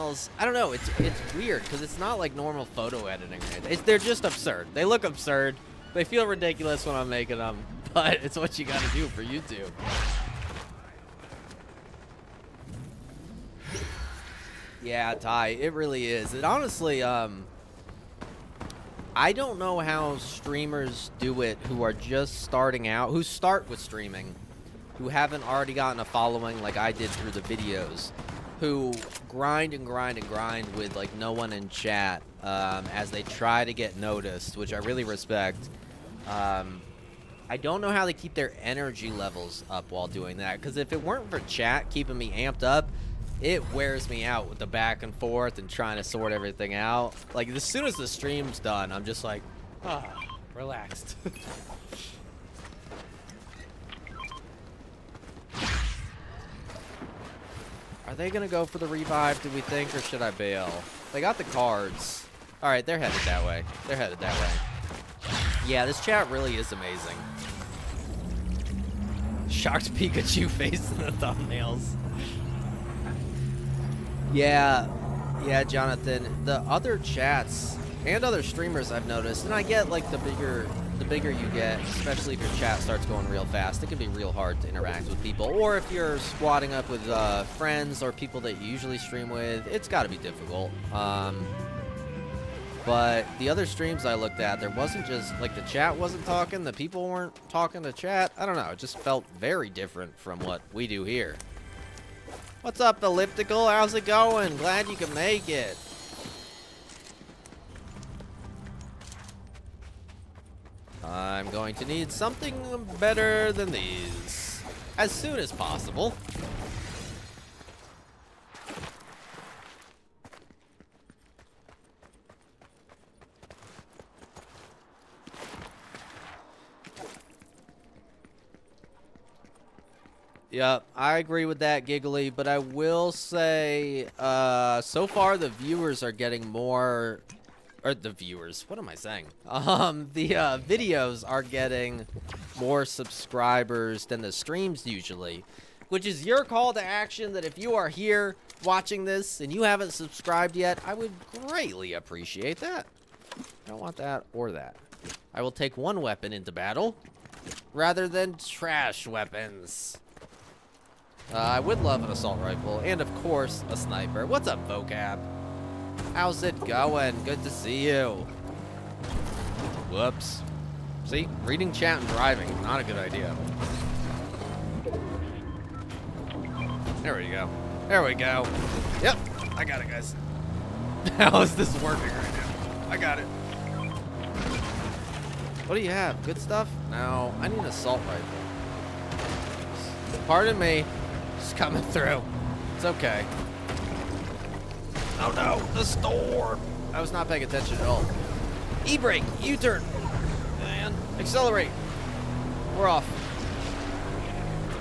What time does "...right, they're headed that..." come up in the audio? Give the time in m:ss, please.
1:02.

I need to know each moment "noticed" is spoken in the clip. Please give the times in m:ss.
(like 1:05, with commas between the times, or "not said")
0:33, 1:19.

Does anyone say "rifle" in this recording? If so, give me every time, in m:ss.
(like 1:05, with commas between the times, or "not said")
2:42, 3:08.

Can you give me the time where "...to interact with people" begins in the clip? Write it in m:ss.
1:24.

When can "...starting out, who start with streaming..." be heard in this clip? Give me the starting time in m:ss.
0:22.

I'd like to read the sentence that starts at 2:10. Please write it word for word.
Yeah, I agree with that, Giggly, but I will say uh, so far the viewers are getting more or the viewers.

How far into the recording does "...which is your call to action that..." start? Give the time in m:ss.
2:25.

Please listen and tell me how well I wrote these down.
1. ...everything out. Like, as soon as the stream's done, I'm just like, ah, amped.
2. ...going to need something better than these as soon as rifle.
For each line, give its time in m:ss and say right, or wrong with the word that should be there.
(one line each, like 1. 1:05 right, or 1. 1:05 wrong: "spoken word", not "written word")
1. 0:46 wrong: "relaxed", not "amped"
2. 1:51 wrong: "possible", not "rifle".